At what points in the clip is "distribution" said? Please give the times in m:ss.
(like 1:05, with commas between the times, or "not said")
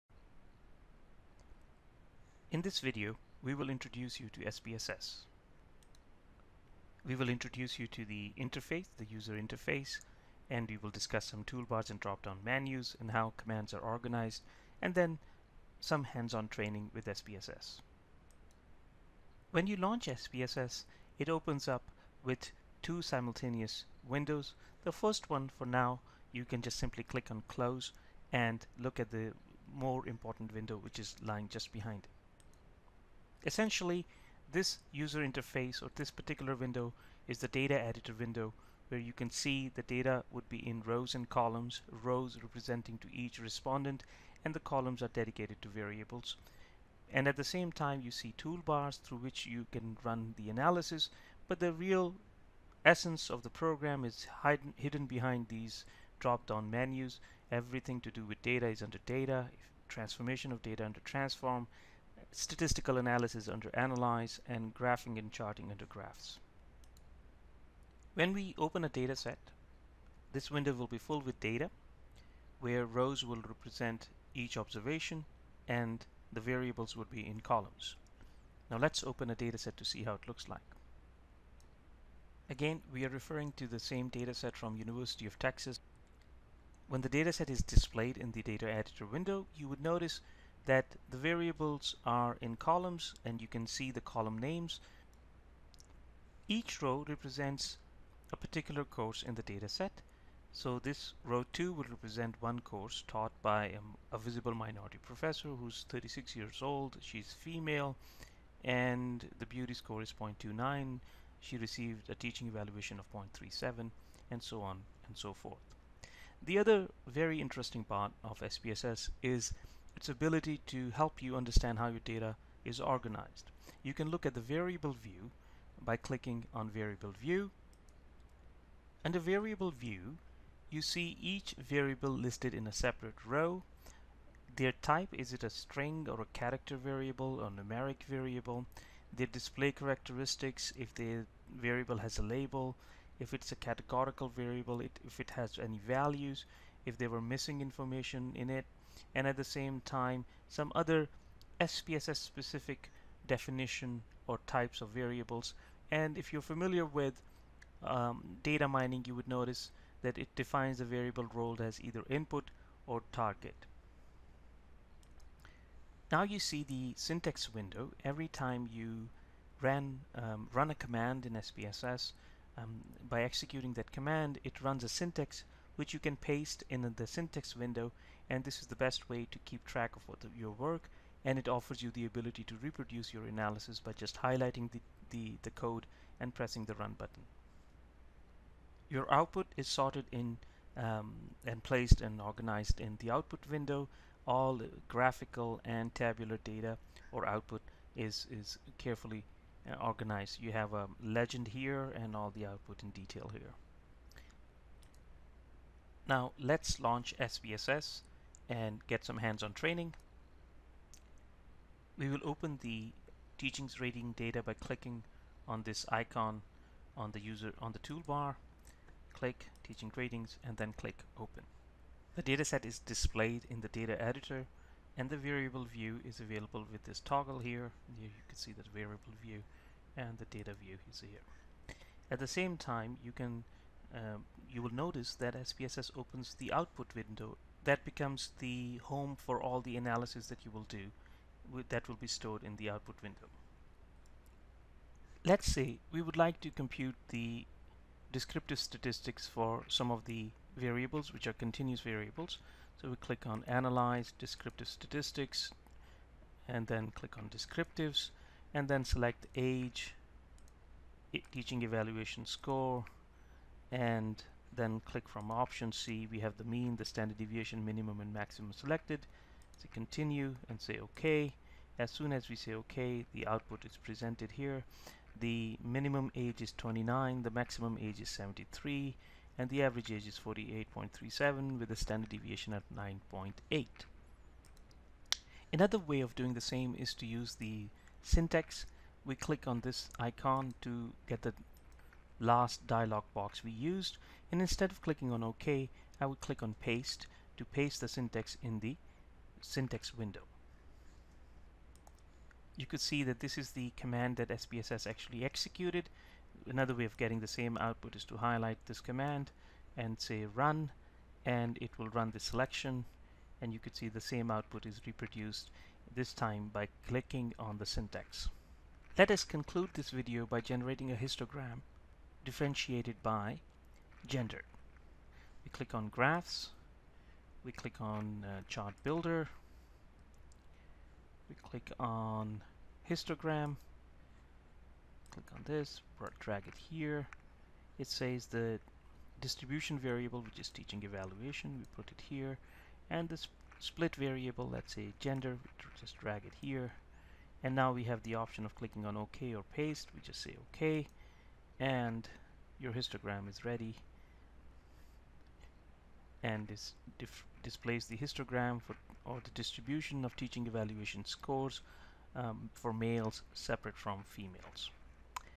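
5:39, 5:59.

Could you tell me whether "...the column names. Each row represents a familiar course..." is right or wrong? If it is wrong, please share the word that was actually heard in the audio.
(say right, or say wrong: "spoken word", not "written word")
wrong: "particular", not "familiar".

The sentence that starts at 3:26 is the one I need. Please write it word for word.
Now let's launch SPSS and get some hands-on training.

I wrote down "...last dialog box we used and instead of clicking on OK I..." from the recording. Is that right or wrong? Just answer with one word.
right.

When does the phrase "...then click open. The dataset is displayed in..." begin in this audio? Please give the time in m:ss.
3:40.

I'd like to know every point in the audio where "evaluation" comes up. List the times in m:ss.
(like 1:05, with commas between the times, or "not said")
1:52, 4:21, 5:40, 6:00.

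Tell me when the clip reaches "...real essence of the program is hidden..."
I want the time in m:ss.
0:51.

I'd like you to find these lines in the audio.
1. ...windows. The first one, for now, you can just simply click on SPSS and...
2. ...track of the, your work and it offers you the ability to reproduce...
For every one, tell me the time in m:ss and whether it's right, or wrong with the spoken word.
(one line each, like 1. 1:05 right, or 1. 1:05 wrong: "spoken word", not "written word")
1. 0:24 wrong: "Close", not "SPSS"
2. 2:59 right.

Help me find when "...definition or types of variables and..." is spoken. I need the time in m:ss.
2:33.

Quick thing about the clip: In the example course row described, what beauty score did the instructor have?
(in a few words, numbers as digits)
0.29.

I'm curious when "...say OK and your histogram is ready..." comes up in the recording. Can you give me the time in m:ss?
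5:50.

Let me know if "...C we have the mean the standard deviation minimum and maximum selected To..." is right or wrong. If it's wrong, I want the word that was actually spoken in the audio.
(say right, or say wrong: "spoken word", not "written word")
right.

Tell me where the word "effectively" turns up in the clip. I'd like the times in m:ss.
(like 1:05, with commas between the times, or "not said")
not said.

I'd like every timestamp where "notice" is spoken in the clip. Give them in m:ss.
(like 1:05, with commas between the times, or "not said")
1:29, 2:39, 3:54.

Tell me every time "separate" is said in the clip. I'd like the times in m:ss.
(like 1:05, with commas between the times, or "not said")
2:12, 6:03.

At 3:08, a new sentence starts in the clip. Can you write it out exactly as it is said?
Your output is sorted in um, and placed and organized in the output window.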